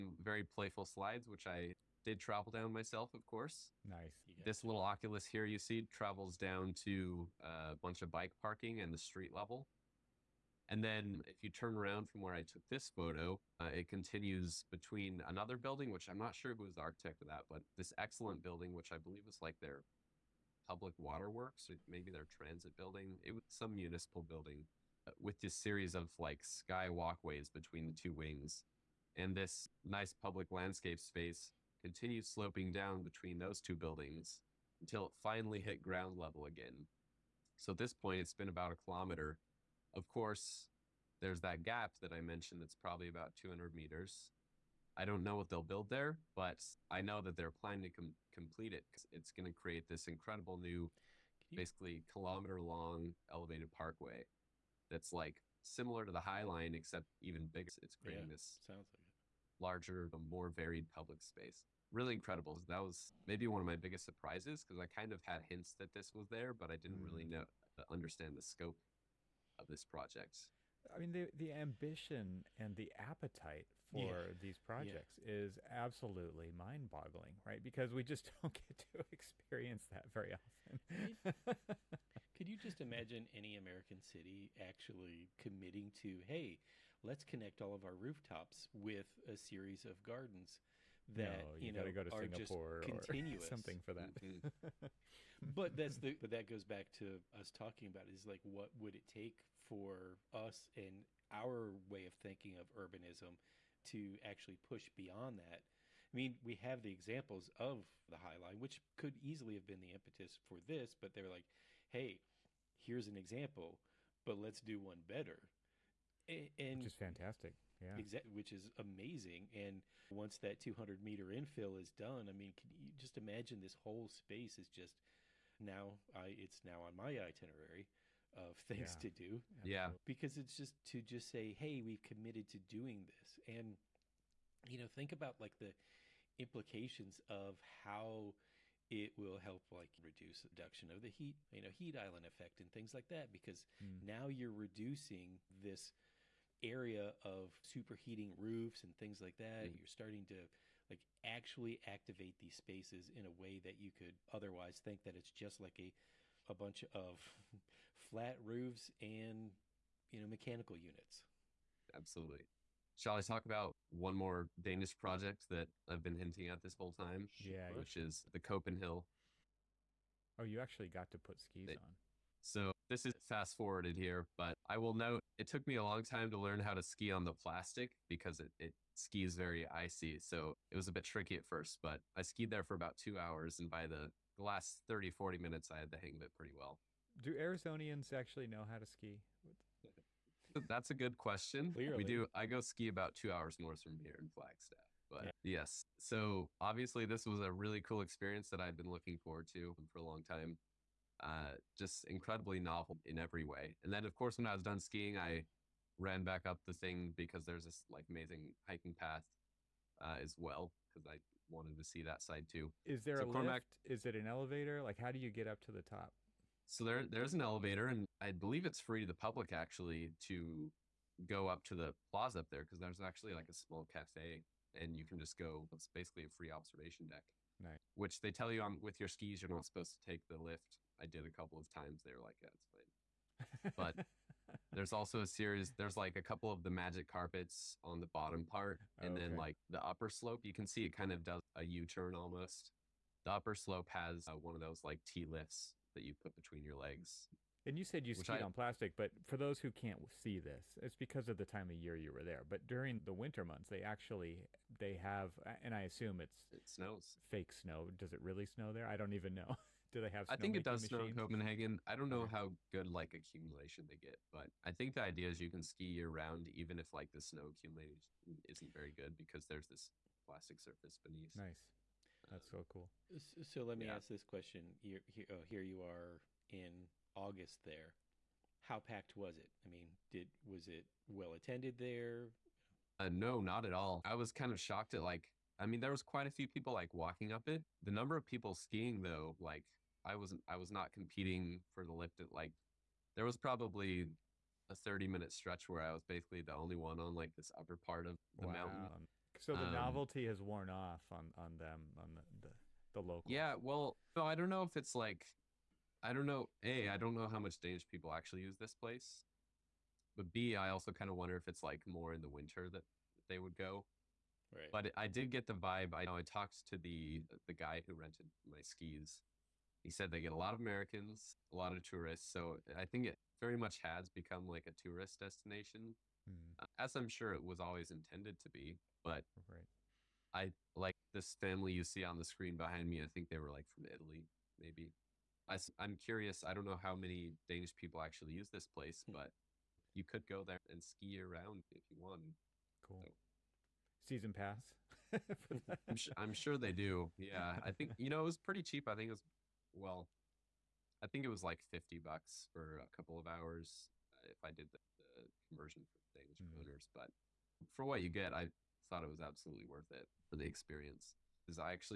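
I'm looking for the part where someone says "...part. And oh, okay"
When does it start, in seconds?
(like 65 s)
238 s.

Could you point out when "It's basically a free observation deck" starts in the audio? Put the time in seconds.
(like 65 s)
225 s.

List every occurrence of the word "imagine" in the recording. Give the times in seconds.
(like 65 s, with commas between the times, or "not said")
82 s, 123 s.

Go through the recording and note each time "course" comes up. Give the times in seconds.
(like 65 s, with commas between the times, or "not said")
3 s, 40 s, 204 s.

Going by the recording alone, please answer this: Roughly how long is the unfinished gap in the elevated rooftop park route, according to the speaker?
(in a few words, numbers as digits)
200 meters.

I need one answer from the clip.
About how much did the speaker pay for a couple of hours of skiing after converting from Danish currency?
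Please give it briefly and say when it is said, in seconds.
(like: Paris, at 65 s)
$50, at 351 s.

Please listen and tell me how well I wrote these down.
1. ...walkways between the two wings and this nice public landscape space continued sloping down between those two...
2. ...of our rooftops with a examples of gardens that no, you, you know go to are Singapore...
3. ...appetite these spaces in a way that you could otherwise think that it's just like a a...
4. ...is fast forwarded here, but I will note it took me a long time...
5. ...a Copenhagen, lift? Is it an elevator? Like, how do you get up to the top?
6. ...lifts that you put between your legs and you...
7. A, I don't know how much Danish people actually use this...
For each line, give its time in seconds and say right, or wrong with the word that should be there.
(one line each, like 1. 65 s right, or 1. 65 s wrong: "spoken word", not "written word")
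1. 26 s right
2. 87 s wrong: "series", not "examples"
3. 151 s wrong: "activate", not "appetite"
4. 173 s right
5. 213 s wrong: "Cormac", not "Copenhagen"
6. 245 s right
7. 306 s right.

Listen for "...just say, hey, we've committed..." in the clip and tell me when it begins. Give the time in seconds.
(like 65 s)
131 s.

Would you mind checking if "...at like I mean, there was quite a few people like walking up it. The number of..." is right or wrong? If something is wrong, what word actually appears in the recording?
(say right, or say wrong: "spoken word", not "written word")
right.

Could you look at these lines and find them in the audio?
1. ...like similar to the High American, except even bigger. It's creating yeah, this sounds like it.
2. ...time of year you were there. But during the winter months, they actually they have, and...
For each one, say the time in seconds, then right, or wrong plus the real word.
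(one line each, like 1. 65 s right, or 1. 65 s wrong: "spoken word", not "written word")
1. 55 s wrong: "Line", not "American"
2. 251 s right.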